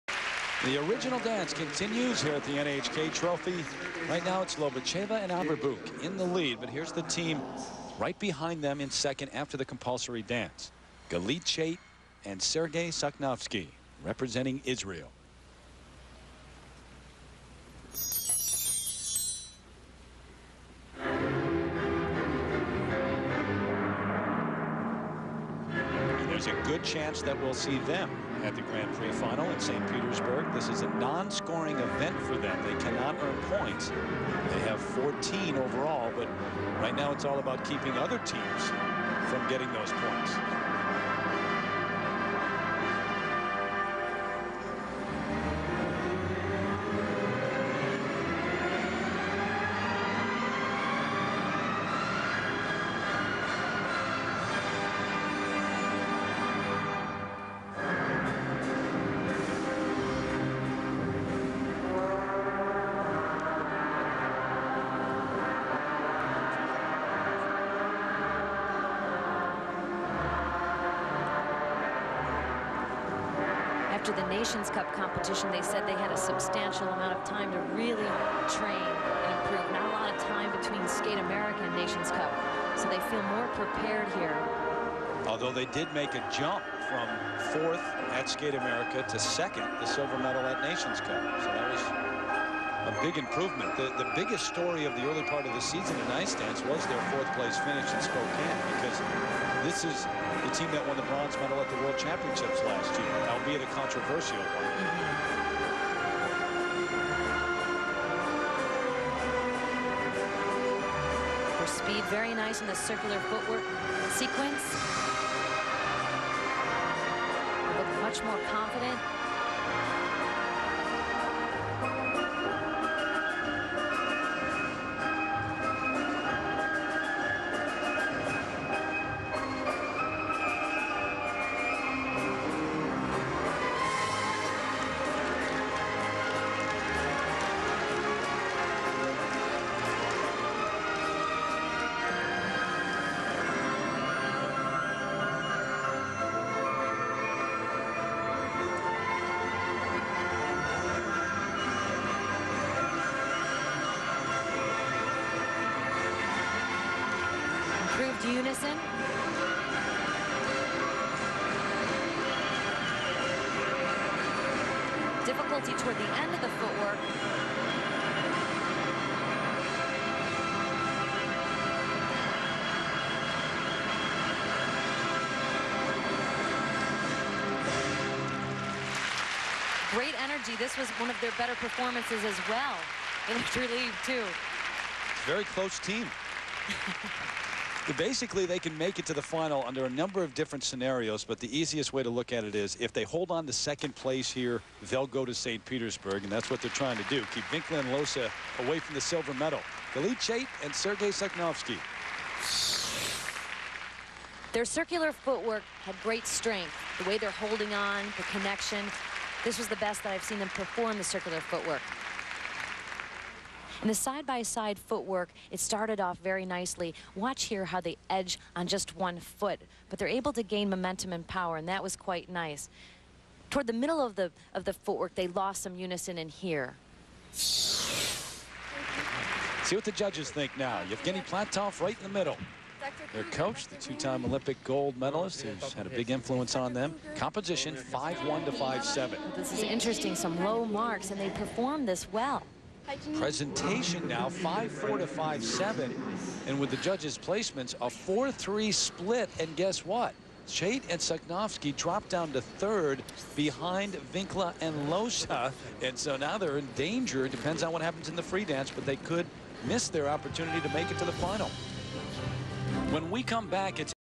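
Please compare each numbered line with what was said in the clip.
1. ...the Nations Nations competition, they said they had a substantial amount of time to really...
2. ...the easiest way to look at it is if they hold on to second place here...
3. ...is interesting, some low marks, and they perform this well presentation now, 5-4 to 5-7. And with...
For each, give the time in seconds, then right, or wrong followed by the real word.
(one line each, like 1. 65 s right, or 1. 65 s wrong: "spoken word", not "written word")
1. 74 s wrong: "Cup", not "Nations"
2. 191 s right
3. 239 s right.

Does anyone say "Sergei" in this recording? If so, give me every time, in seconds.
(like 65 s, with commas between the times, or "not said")
12 s, 200 s.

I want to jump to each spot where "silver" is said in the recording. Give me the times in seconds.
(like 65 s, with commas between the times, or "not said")
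89 s, 199 s.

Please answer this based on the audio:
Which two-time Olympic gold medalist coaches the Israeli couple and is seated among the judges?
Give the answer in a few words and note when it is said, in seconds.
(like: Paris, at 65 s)
Evgeny Platov, at 230 s.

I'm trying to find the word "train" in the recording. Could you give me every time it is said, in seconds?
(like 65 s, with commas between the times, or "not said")
78 s.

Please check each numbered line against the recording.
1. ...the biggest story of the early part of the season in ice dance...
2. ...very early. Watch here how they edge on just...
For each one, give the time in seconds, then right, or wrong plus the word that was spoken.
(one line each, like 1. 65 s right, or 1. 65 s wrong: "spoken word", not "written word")
1. 94 s right
2. 216 s wrong: "nicely", not "early".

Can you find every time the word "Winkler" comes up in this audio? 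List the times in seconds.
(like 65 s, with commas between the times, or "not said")
197 s, 254 s.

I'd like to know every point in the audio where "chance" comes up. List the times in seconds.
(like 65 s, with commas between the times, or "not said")
26 s.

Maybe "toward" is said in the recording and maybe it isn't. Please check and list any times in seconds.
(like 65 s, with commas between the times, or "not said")
165 s, 223 s.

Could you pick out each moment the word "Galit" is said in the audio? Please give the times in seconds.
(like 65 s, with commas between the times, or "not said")
11 s, 199 s.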